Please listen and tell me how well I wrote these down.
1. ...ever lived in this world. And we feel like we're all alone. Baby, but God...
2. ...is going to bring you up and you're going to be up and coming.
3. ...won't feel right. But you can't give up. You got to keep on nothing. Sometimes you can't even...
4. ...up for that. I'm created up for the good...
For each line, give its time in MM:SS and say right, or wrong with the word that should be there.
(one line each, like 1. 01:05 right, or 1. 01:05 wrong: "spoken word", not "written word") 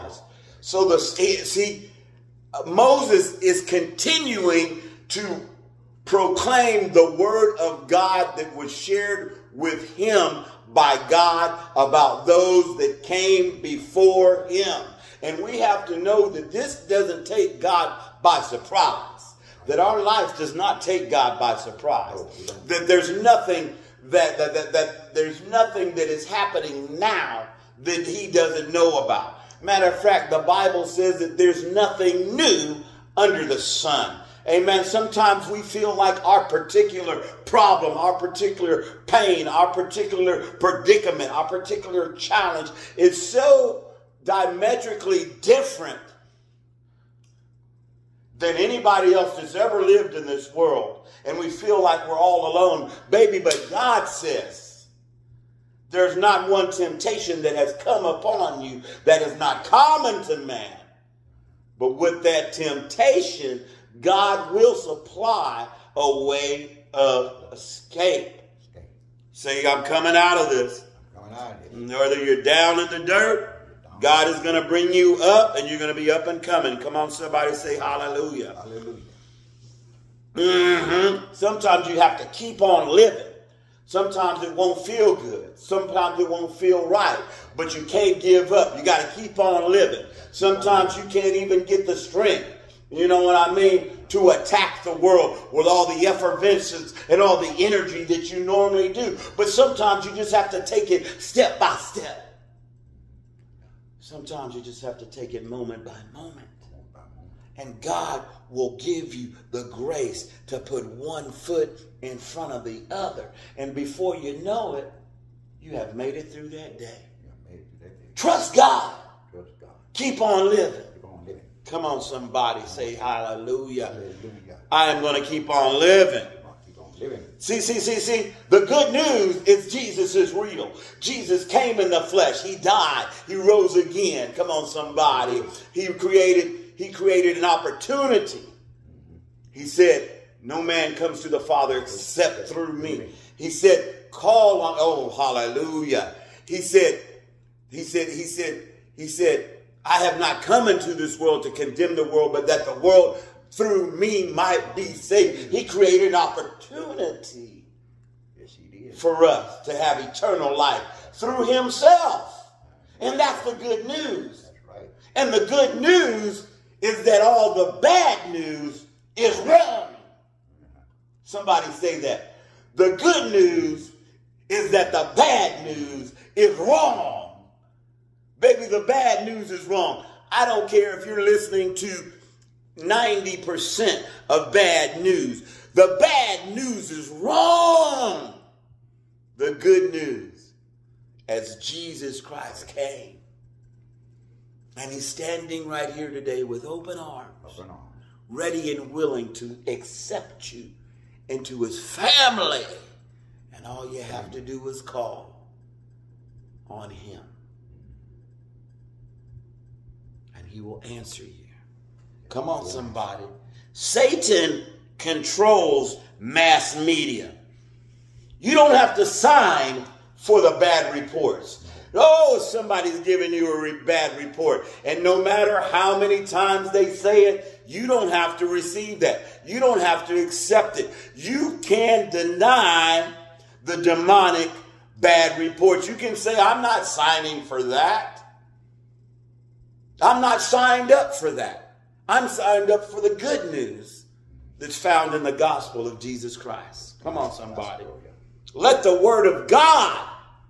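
1. 00:49 right
2. 01:14 right
3. 01:26 wrong: "living", not "nothing"
4. 04:00 wrong: "signed", not "created".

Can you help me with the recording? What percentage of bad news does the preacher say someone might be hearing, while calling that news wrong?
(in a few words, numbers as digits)
90%.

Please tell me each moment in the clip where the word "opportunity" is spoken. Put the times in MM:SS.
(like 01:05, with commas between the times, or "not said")
02:17, 02:36.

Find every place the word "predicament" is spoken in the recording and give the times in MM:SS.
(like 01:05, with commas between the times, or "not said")
00:40.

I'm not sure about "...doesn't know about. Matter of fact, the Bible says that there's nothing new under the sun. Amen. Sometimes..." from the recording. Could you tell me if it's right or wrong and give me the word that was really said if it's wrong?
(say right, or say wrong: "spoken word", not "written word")
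right.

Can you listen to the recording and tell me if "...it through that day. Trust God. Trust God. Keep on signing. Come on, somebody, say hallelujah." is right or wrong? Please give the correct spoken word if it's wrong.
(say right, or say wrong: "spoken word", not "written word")
wrong: "living", not "signing".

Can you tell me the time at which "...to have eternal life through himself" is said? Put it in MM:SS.
02:39.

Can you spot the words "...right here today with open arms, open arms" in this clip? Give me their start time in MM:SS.
03:15.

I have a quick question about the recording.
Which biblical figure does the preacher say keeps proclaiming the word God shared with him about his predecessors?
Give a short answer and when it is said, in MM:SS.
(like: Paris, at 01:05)
Moses, at 00:02.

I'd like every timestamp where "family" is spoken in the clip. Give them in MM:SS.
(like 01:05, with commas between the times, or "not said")
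03:21.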